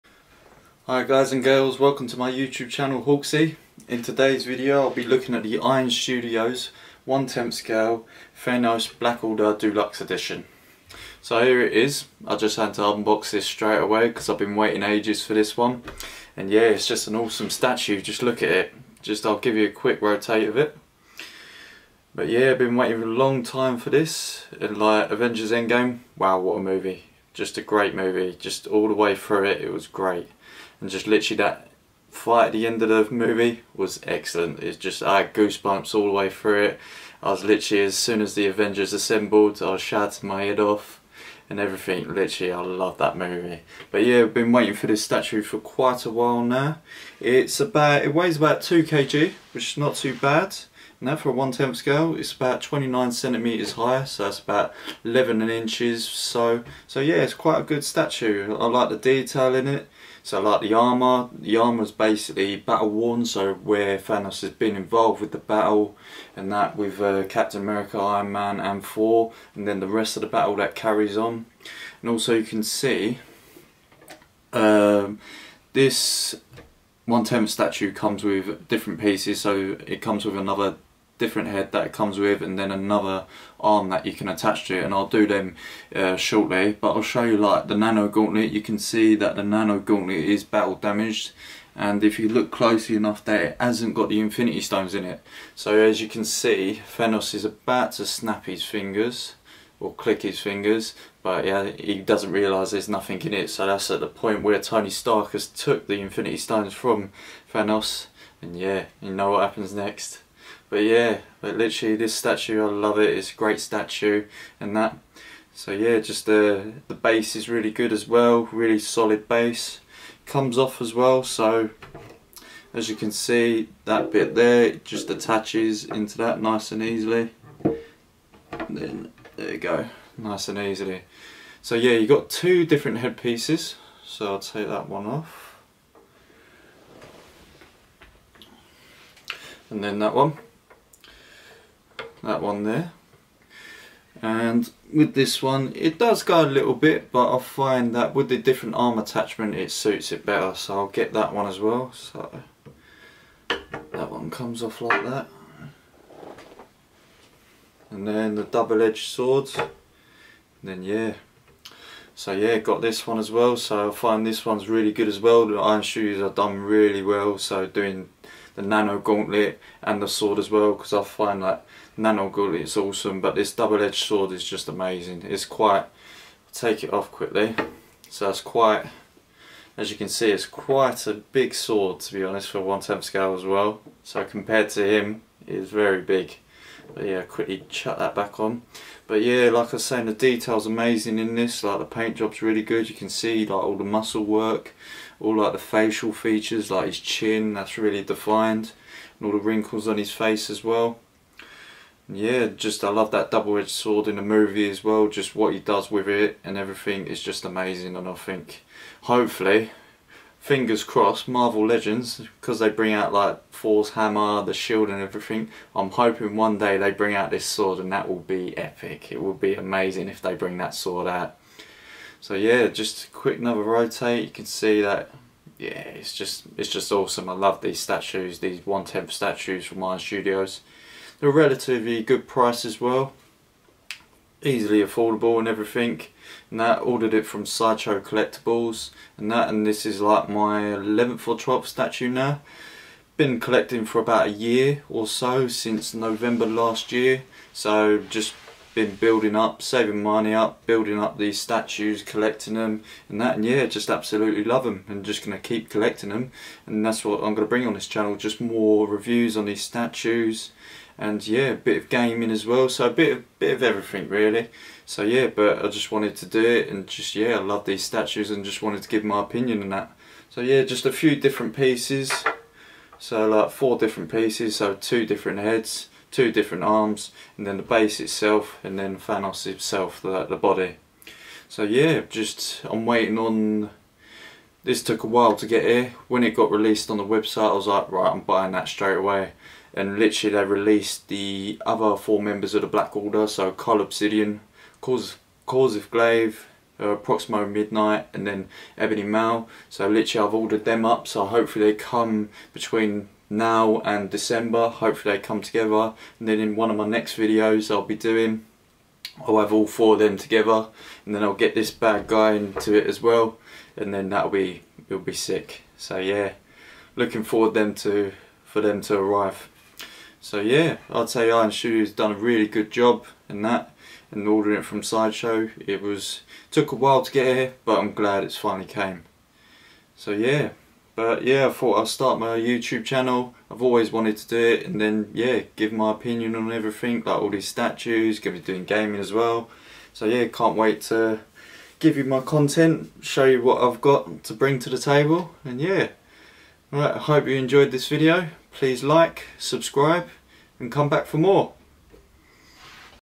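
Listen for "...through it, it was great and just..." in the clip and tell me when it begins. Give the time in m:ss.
0:29.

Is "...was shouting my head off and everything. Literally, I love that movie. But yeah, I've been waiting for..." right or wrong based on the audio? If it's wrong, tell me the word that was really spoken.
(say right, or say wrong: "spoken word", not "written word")
right.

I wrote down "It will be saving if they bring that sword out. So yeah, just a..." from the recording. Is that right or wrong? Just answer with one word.
wrong.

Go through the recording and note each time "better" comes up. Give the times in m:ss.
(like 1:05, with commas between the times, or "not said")
2:30.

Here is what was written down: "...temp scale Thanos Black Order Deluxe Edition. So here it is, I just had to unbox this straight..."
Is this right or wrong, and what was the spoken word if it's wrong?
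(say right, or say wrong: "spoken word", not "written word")
right.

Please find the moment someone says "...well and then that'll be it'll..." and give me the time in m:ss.
5:13.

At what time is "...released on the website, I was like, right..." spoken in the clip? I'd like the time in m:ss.
4:46.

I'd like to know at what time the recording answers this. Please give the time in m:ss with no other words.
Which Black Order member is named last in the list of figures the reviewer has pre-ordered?
4:58.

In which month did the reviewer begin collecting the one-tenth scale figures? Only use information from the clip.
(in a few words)
November.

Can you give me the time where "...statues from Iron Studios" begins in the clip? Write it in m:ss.
3:49.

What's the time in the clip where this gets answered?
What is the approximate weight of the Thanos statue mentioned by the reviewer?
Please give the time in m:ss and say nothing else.
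0:48.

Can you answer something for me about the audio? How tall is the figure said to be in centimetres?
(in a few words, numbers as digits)
29 centimetres.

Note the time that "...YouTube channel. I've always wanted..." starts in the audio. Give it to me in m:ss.
5:32.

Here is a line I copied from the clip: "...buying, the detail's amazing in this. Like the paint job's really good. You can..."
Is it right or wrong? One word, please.
wrong.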